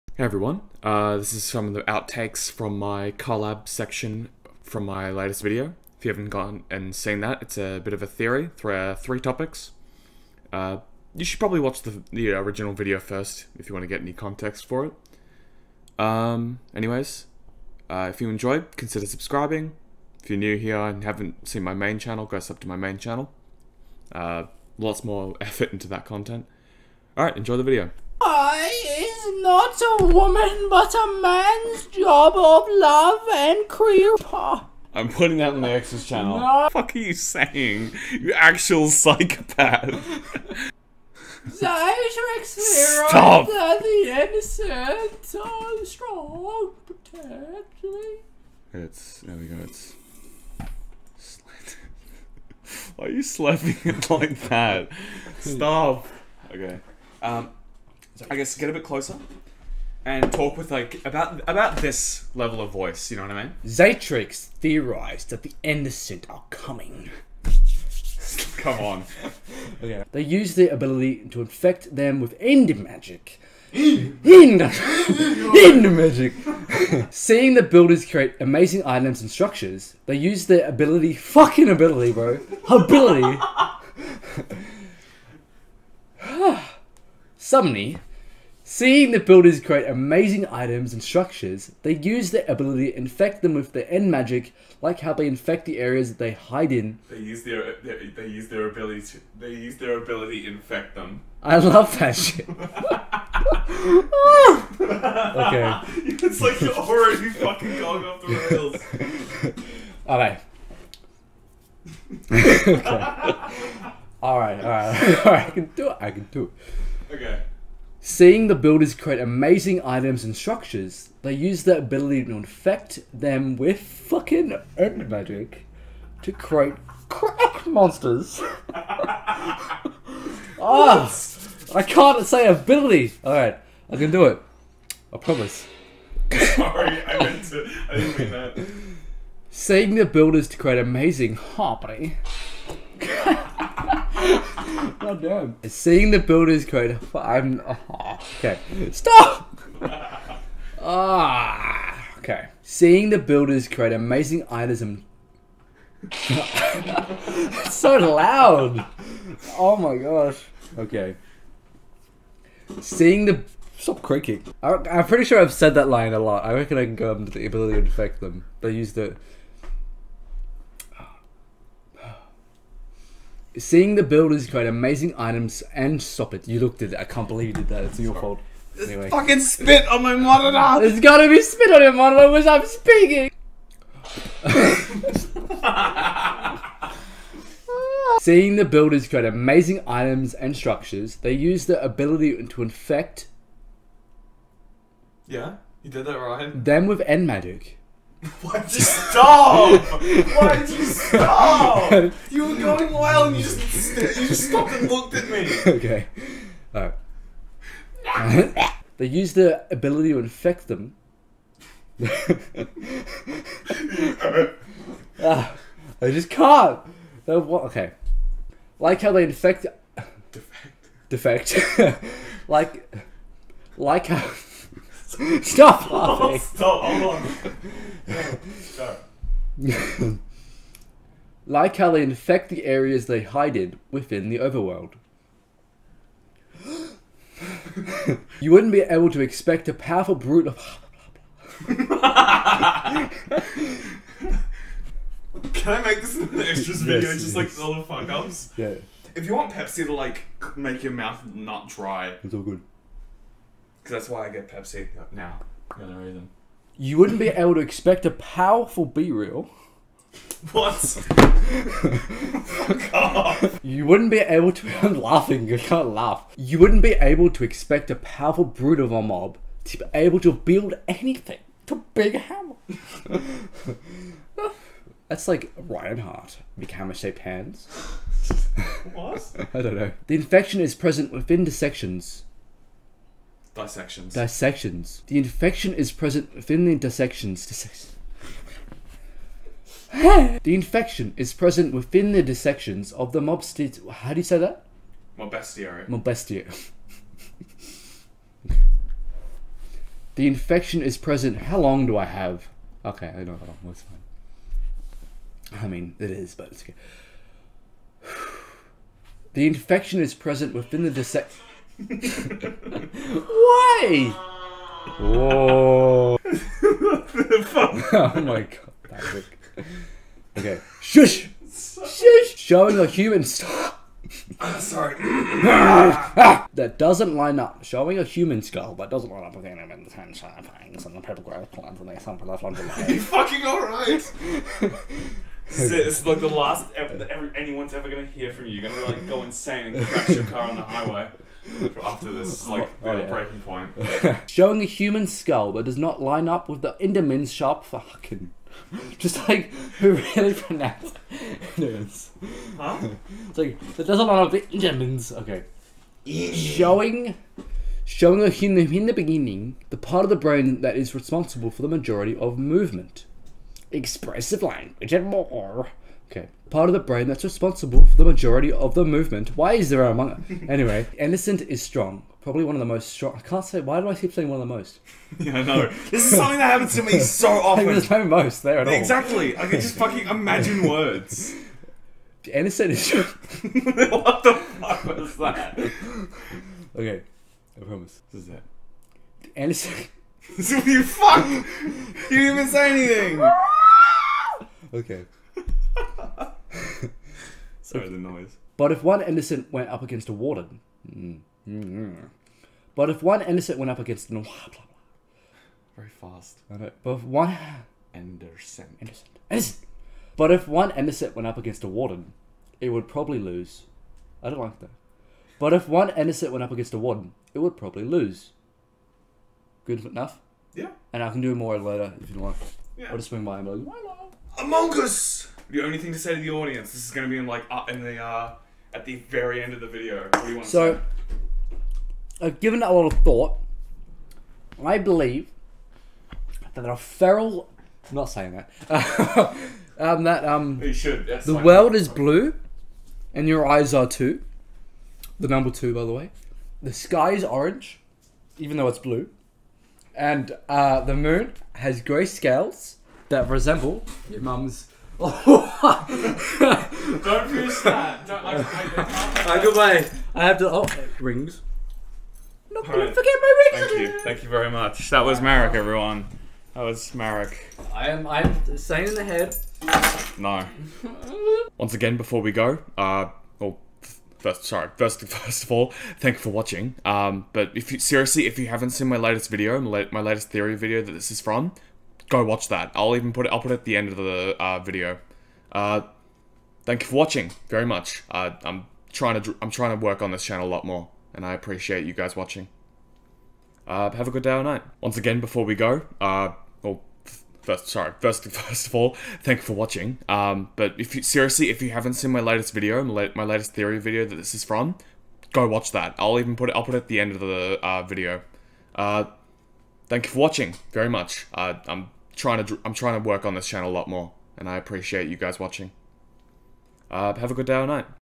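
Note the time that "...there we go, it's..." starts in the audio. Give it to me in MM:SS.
00:49.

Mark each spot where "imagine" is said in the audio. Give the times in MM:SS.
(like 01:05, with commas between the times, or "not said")
06:20.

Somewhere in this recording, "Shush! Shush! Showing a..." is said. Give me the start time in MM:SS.
05:20.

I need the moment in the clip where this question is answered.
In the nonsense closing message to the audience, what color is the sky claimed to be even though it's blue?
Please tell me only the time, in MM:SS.
07:27.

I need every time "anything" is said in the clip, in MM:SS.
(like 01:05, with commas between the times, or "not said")
04:30, 06:33.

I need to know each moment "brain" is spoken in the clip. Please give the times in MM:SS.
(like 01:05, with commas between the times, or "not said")
06:00, 06:06.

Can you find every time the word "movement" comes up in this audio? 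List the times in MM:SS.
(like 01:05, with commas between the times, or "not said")
06:02, 06:08.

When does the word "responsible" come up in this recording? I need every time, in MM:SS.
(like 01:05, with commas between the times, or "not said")
06:00, 06:07.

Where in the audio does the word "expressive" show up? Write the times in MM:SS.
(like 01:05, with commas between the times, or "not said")
06:03.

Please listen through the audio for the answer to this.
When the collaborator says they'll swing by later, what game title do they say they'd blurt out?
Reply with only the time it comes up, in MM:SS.
07:04.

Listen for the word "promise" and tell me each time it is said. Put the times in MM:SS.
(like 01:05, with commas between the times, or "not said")
02:15, 06:27.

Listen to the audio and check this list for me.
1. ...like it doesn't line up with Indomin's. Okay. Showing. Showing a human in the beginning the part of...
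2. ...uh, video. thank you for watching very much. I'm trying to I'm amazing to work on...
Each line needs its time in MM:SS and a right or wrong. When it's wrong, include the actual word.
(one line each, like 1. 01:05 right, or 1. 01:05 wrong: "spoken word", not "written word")
1. 05:53 right
2. 08:27 wrong: "trying", not "amazing".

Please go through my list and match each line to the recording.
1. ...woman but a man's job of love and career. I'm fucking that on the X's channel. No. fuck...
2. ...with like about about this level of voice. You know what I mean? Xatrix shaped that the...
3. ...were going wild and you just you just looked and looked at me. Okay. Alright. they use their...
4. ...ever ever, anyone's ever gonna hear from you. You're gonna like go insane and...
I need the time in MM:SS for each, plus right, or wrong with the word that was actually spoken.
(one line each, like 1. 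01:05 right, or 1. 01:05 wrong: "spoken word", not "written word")
1. 00:30 wrong: "putting", not "fucking"
2. 01:00 wrong: "theorized", not "shaped"
3. 03:22 wrong: "stopped", not "looked"
4. 05:36 right.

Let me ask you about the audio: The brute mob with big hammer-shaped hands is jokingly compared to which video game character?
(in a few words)
Reinhardt.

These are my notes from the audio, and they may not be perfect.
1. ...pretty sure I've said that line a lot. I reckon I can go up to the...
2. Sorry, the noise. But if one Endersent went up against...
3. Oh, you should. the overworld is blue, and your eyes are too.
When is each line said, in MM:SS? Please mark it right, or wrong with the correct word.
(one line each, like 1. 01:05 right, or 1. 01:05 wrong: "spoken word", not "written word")
1. 02:45 right
2. 06:37 right
3. 07:20 wrong: "world", not "overworld".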